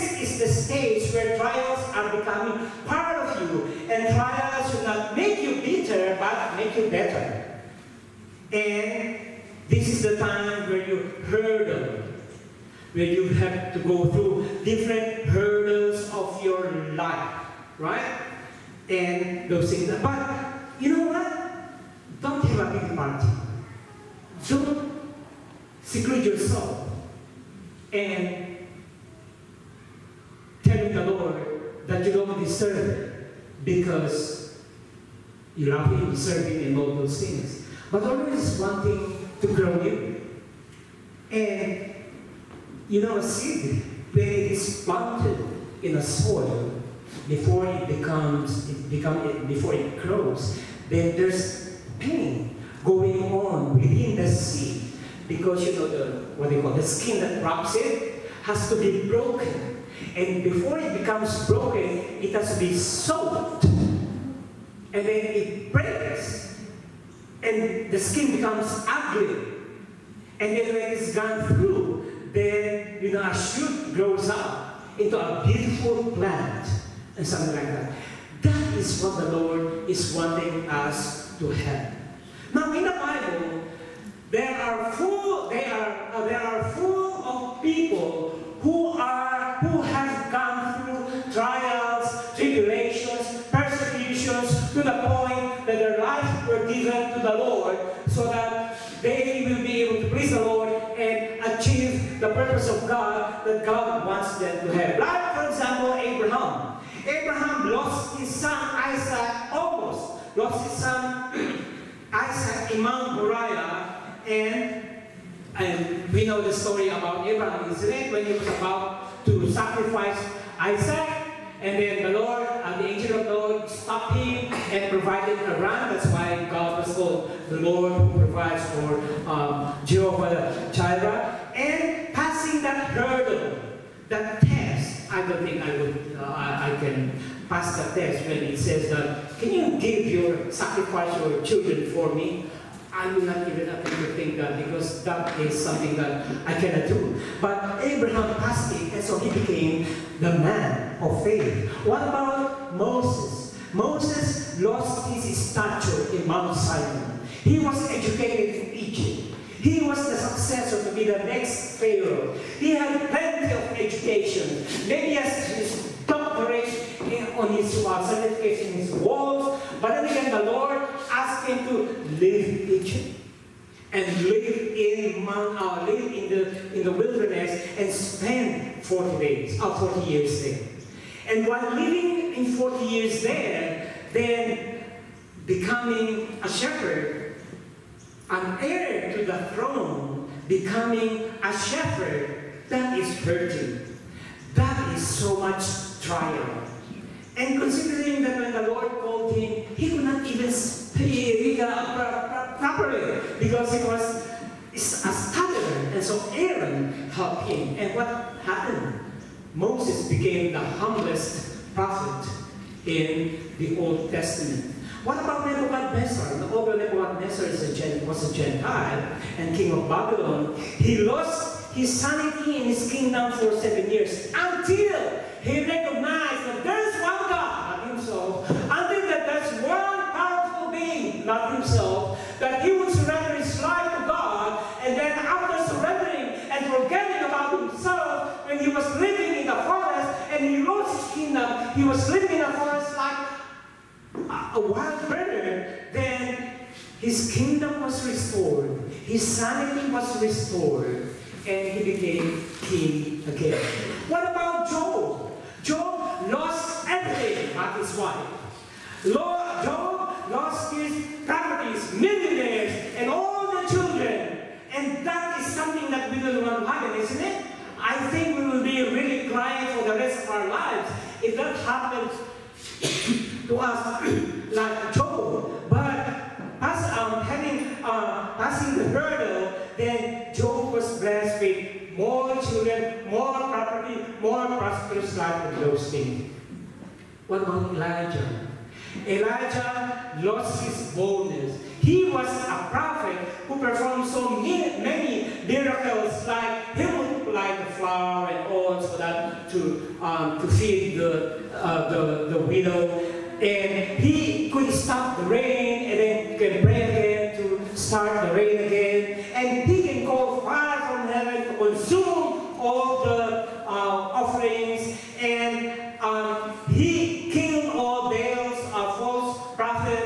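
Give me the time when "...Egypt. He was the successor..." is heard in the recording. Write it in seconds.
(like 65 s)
158 s.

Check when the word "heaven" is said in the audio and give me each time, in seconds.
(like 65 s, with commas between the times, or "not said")
311 s.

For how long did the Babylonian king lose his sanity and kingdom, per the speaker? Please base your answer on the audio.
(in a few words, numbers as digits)
7 years.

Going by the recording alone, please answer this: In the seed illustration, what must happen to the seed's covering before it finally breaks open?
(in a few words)
soaked.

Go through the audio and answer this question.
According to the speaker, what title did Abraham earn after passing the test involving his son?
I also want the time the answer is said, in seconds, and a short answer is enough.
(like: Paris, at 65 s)
the man of faith, at 150 s.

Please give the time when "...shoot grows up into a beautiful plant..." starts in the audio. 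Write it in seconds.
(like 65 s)
73 s.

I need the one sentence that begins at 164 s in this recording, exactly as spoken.
Maybe has his doctorate on his uh, certification, his walls.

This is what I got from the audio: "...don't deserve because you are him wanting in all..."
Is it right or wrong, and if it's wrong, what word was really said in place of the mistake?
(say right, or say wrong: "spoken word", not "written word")
wrong: "serving", not "wanting".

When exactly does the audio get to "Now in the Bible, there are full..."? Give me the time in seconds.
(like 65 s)
82 s.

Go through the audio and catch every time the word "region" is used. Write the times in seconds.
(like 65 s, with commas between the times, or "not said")
not said.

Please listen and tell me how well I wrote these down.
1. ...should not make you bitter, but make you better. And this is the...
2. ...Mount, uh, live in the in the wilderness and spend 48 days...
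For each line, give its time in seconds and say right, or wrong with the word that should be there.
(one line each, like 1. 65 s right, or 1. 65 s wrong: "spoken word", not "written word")
1. 4 s right
2. 175 s wrong: "40", not "48".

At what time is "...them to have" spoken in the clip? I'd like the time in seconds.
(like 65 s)
104 s.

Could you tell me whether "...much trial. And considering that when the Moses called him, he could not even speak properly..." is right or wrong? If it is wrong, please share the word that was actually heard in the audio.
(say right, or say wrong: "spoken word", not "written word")
wrong: "Lord", not "Moses".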